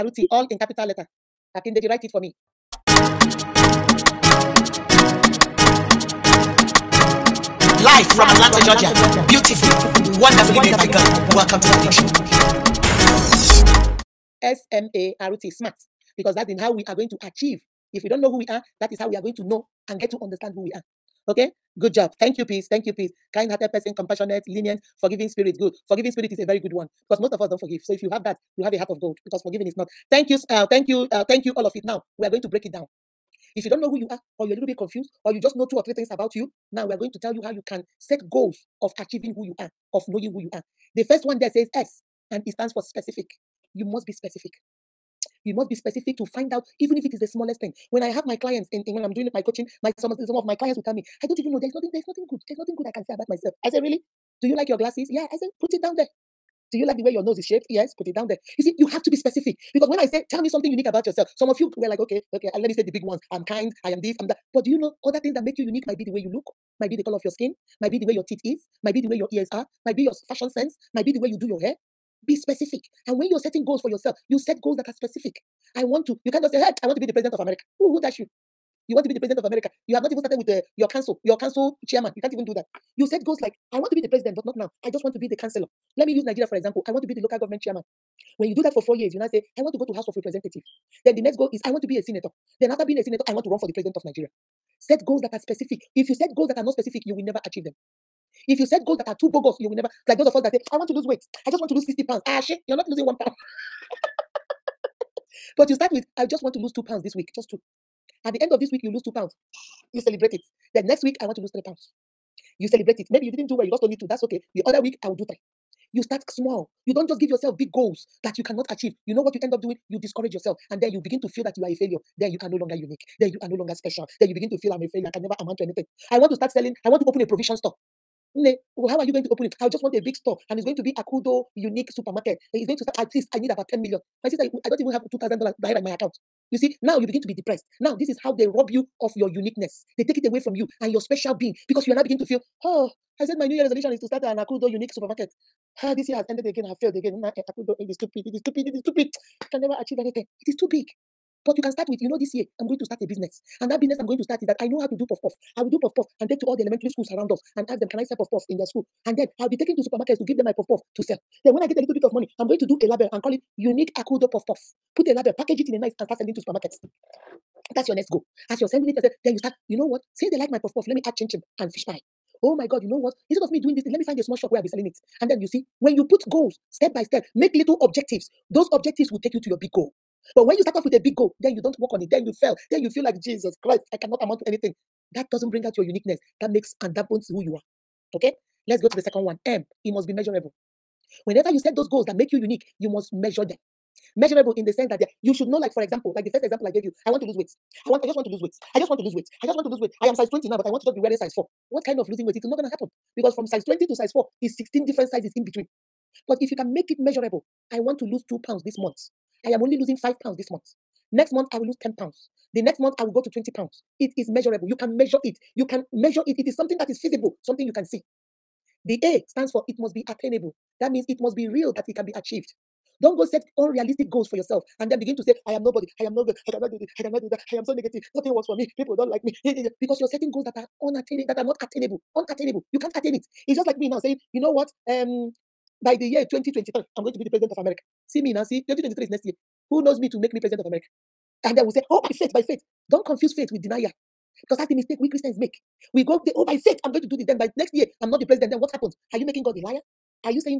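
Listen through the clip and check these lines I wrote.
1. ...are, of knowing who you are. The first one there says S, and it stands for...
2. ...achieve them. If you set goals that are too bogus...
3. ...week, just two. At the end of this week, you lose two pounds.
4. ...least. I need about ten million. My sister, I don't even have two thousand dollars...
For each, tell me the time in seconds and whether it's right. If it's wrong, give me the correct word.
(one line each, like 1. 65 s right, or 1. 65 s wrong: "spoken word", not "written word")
1. 39 s right
2. 97 s right
3. 107 s right
4. 133 s right.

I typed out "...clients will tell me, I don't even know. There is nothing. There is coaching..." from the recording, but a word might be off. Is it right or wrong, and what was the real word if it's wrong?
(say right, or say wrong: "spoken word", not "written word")
wrong: "nothing", not "coaching".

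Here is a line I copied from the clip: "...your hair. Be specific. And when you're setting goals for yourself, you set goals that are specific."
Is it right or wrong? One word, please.
right.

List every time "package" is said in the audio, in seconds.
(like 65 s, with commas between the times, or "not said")
165 s.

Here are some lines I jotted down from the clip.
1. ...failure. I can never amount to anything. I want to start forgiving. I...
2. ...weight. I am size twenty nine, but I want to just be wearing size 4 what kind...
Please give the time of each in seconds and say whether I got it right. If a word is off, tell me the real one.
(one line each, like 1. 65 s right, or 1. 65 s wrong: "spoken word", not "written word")
1. 124 s wrong: "selling", not "forgiving"
2. 199 s right.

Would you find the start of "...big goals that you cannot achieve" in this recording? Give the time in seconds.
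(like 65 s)
117 s.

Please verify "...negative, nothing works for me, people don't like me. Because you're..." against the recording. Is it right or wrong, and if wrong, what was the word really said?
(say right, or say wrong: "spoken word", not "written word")
right.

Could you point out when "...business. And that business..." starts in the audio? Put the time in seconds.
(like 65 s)
153 s.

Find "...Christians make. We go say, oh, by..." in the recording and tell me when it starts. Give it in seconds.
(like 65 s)
245 s.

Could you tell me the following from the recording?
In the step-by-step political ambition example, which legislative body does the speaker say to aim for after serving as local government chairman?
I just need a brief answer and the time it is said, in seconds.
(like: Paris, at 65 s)
House of Representatives, at 89 s.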